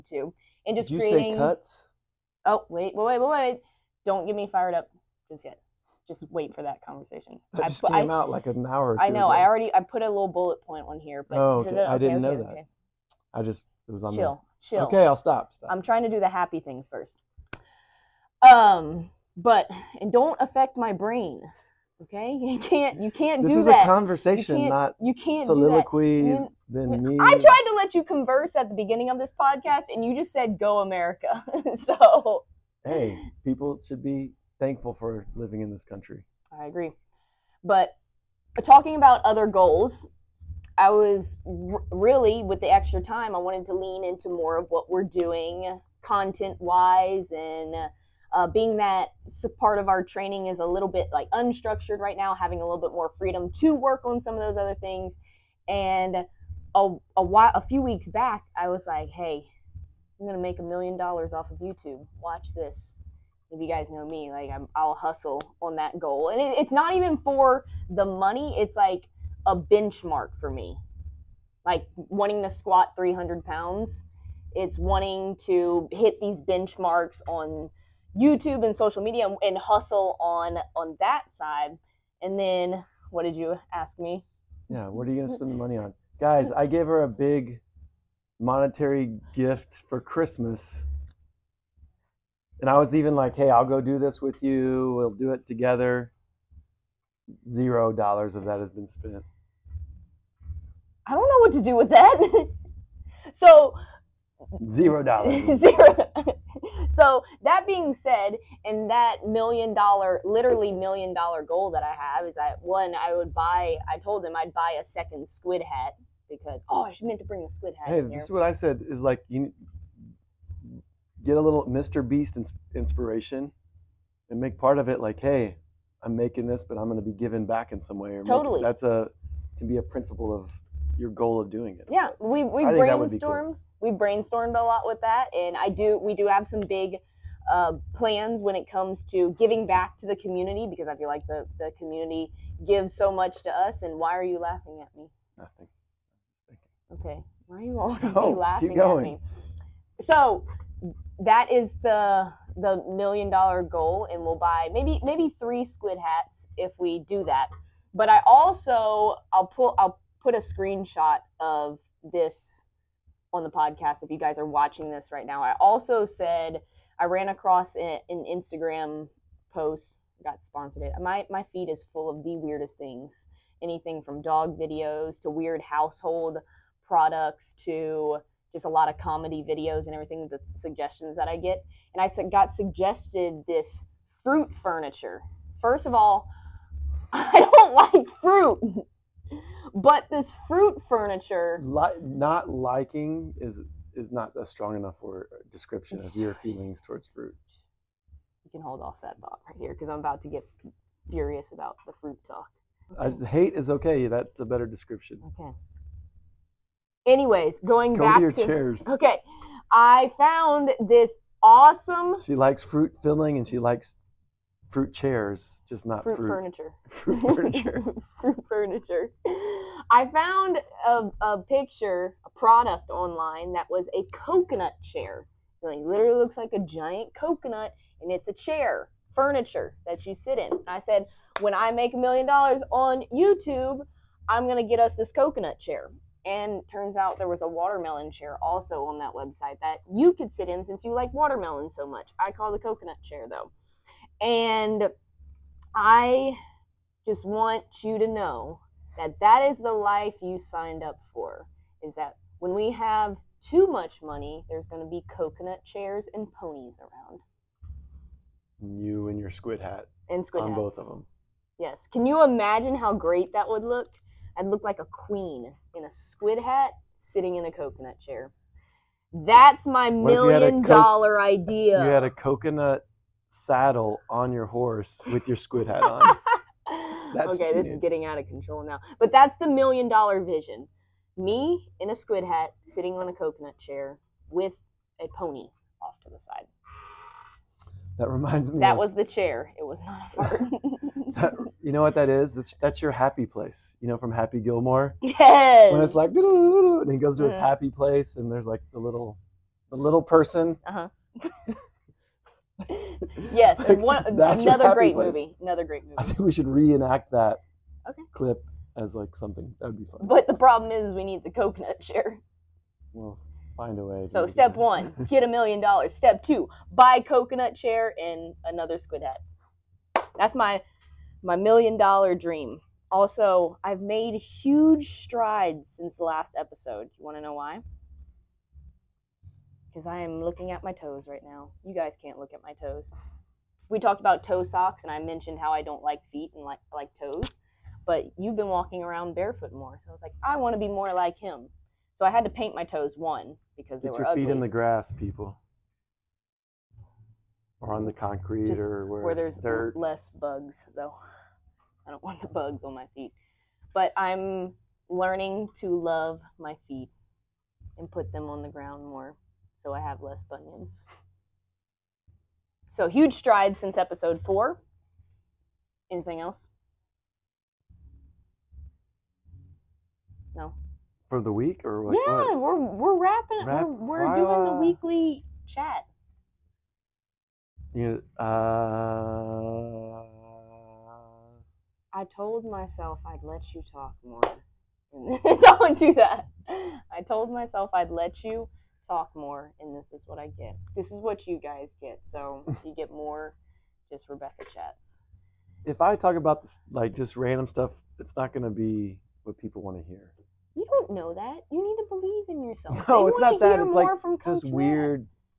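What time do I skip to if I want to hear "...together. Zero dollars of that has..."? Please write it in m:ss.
1:35.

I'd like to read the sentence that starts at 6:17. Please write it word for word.
You uh I told myself I'd let you talk more.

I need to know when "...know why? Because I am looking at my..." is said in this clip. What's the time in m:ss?
5:27.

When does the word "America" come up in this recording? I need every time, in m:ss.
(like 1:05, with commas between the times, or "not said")
0:30.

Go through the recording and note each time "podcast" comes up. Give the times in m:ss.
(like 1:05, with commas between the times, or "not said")
0:29, 2:43.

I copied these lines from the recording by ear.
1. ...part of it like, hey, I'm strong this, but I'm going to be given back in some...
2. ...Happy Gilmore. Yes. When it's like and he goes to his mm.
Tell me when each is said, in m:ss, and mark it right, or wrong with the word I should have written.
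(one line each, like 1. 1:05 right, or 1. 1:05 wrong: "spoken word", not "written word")
1. 2:04 wrong: "making", not "strong"
2. 4:54 right.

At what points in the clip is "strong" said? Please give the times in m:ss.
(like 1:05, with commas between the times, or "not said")
3:14.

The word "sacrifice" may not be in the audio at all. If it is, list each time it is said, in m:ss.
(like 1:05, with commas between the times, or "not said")
not said.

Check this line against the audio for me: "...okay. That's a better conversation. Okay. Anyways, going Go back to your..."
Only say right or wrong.
wrong.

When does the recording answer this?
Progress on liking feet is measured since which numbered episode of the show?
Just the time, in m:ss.
6:03.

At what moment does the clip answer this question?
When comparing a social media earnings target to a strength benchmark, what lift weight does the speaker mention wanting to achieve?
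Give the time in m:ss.
1:12.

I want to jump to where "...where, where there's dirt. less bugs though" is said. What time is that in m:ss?
5:48.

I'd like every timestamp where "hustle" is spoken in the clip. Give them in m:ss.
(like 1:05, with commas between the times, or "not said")
1:04, 1:19.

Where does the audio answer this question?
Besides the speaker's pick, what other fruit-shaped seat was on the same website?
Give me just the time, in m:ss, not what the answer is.
3:57.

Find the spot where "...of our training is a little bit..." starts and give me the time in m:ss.
0:49.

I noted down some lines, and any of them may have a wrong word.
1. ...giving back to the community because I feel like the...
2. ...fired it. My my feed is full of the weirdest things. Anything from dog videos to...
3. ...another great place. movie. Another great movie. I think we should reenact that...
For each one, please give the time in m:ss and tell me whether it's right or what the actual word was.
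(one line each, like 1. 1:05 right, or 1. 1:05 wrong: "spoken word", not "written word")
1. 2:19 right
2. 2:50 wrong: "sponsored", not "fired"
3. 5:04 right.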